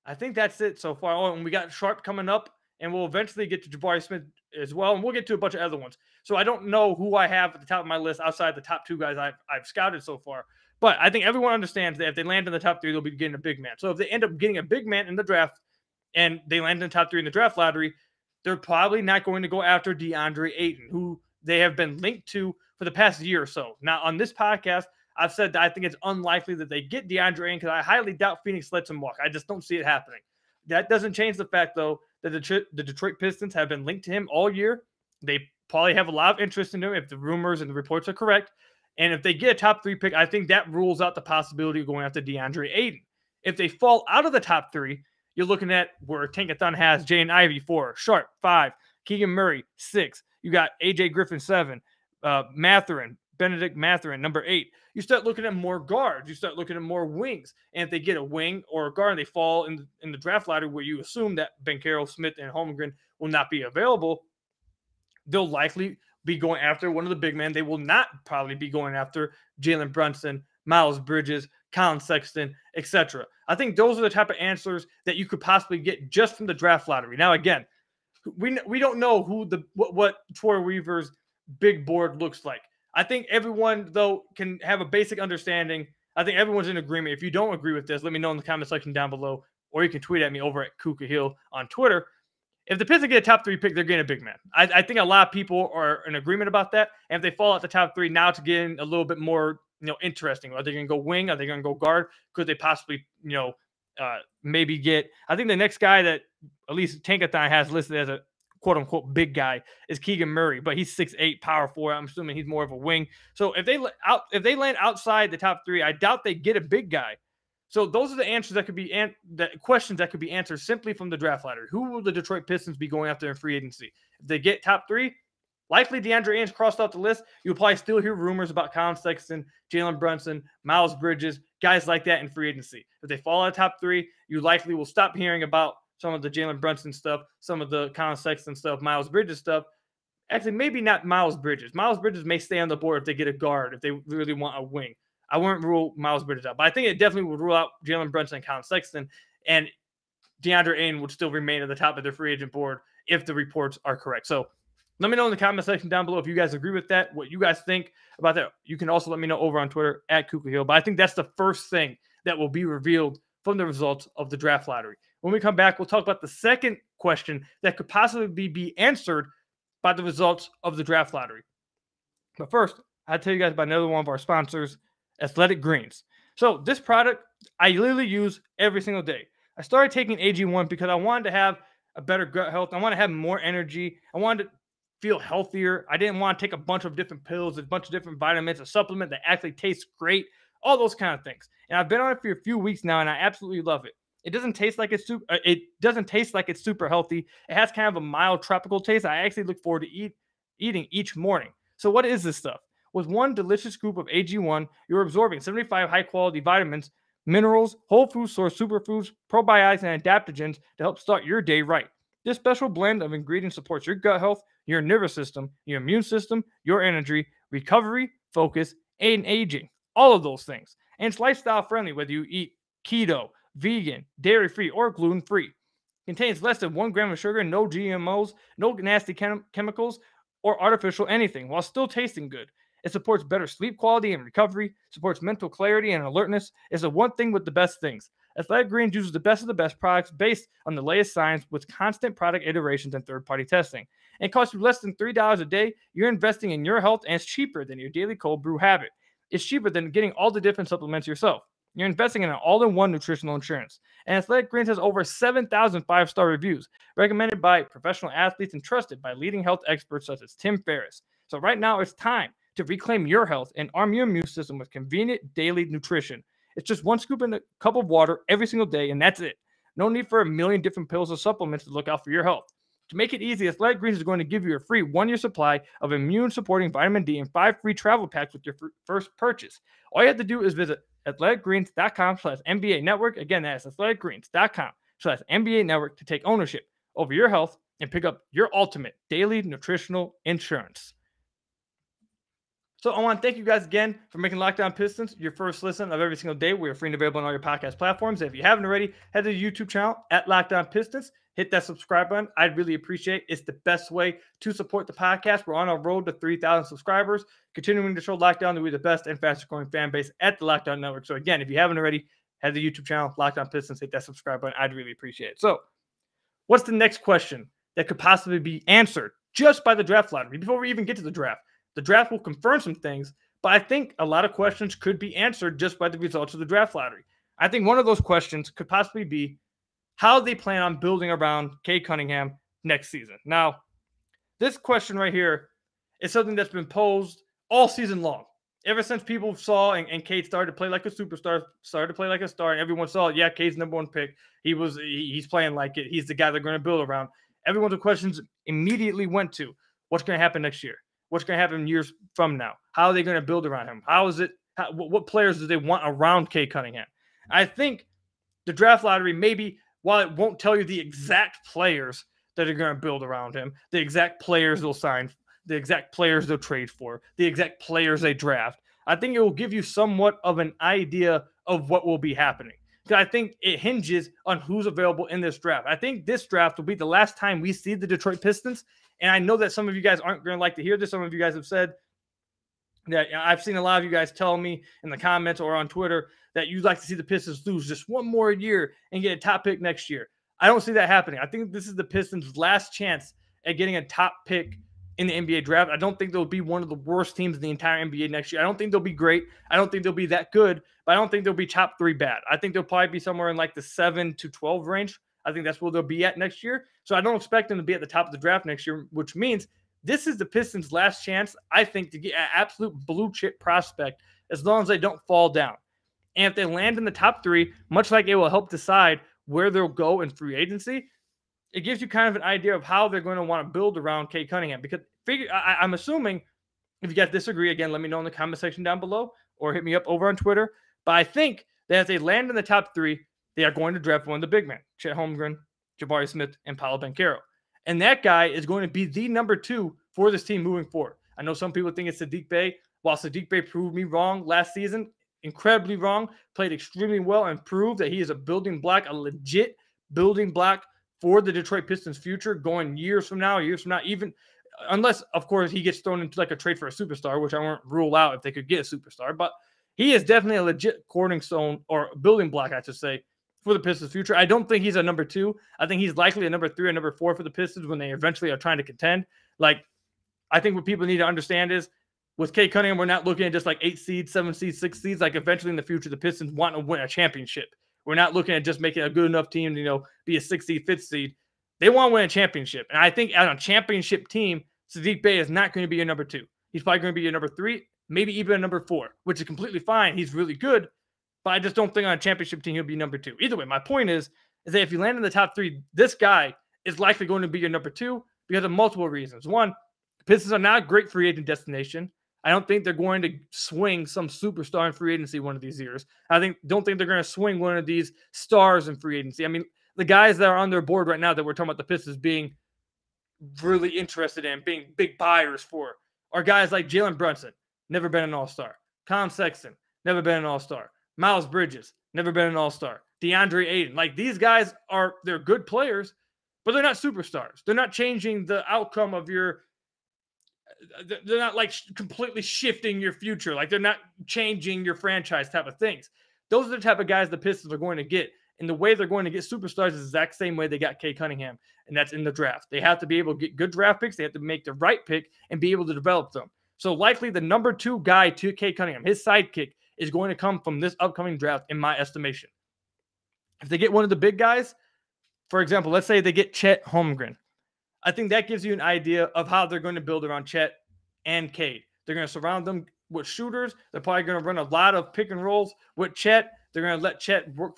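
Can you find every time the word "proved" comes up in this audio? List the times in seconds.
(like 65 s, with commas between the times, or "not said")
443 s, 447 s.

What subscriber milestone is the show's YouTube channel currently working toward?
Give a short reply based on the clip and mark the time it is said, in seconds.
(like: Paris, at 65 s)
3,000, at 306 s.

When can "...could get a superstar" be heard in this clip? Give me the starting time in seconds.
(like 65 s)
458 s.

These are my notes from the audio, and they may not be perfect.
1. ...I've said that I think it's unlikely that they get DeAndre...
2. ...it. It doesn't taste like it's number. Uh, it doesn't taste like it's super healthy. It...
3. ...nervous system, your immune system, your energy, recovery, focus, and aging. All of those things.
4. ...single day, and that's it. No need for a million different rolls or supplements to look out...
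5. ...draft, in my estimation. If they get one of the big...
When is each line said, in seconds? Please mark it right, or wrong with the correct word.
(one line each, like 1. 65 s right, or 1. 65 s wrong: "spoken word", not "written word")
1. 25 s right
2. 193 s wrong: "super", not "number"
3. 214 s right
4. 268 s wrong: "pills", not "rolls"
5. 551 s right.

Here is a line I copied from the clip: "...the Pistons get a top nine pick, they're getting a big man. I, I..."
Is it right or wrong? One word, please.
wrong.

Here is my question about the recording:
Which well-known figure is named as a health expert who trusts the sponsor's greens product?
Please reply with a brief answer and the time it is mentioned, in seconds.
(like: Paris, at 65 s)
Tim Ferriss, at 260 s.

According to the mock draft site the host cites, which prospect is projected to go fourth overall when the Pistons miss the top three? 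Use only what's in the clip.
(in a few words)
Jaden Ivey.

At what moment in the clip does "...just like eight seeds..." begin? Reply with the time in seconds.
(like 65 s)
473 s.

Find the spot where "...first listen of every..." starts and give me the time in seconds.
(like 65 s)
295 s.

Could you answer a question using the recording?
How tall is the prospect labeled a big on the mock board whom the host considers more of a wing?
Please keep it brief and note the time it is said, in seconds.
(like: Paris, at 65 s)
6'8, at 110 s.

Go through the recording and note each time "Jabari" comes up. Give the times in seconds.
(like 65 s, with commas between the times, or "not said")
3 s, 435 s.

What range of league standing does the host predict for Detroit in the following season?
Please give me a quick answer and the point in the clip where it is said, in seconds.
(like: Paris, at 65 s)
7 to 12, at 403 s.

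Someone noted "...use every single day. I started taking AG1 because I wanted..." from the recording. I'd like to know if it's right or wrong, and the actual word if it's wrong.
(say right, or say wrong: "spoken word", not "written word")
right.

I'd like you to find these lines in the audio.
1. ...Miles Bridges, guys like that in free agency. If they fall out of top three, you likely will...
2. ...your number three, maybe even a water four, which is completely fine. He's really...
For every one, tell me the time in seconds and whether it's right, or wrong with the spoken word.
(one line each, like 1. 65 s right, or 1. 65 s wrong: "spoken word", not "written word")
1. 130 s right
2. 487 s wrong: "number", not "water".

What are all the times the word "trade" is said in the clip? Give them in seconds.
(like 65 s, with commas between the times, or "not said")
366 s, 456 s.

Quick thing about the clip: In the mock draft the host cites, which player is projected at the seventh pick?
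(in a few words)
AJ Griffin.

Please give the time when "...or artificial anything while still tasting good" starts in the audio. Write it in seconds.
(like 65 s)
230 s.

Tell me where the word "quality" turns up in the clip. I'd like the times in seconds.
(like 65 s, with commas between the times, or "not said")
206 s, 233 s.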